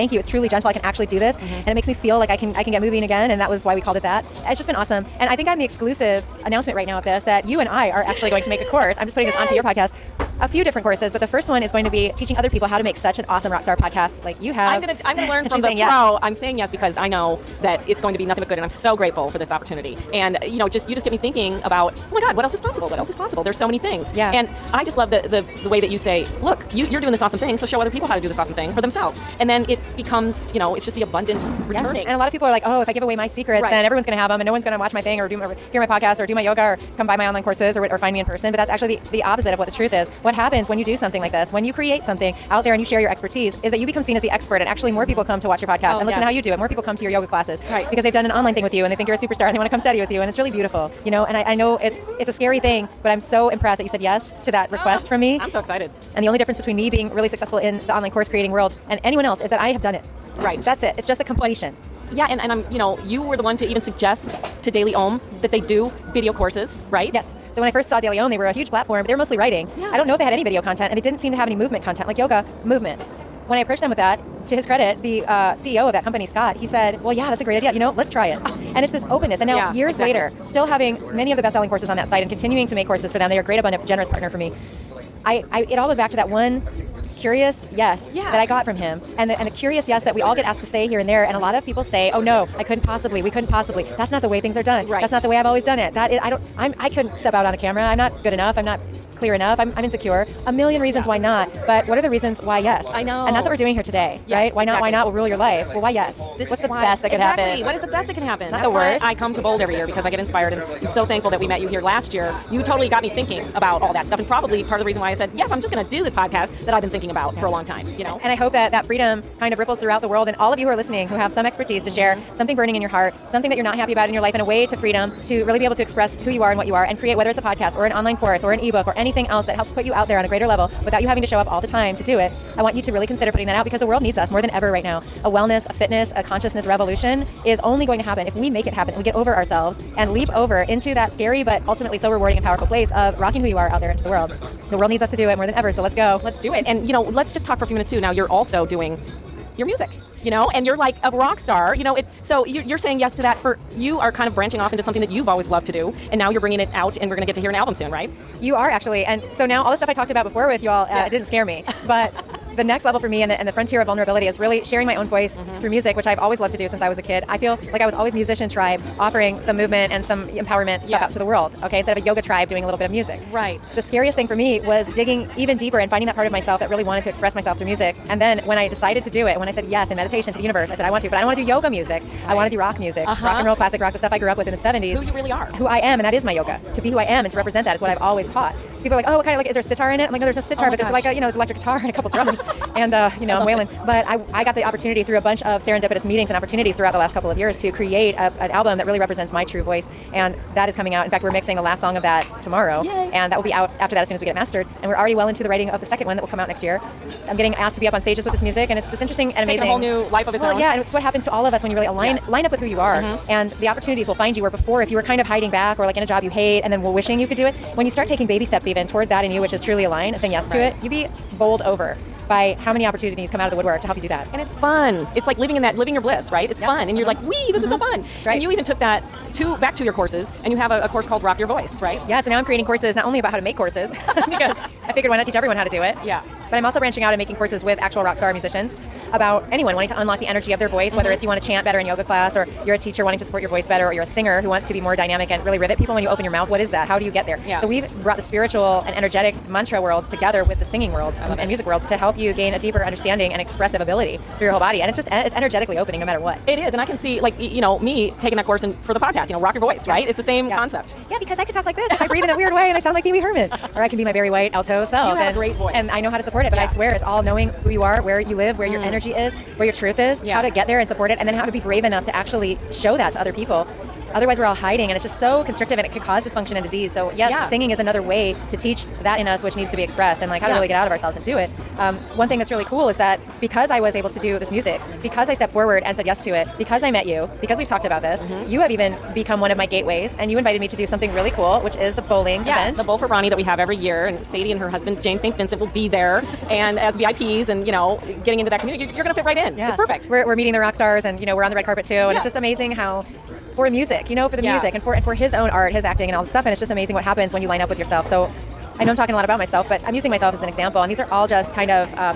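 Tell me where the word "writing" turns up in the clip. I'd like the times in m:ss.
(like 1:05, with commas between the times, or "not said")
1:09, 3:25.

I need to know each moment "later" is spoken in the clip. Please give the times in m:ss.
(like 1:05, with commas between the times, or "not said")
1:20.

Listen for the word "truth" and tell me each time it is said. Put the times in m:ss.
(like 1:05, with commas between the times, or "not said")
0:39, 4:29.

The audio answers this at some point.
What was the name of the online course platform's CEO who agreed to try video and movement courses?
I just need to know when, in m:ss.
1:16.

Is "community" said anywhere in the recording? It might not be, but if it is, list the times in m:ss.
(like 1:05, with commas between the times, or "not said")
4:58.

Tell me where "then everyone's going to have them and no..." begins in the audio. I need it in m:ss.
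0:33.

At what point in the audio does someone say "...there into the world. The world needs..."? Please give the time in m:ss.
2:23.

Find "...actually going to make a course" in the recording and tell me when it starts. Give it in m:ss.
0:08.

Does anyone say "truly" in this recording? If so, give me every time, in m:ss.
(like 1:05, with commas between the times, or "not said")
0:00, 3:39.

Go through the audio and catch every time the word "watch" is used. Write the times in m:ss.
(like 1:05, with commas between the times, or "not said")
0:34, 0:45.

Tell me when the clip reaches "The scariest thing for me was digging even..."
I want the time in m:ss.
2:53.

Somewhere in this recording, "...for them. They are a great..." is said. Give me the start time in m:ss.
1:23.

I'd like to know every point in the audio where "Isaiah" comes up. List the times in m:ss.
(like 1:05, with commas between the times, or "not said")
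not said.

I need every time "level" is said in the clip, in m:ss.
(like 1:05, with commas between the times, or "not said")
2:10, 2:42.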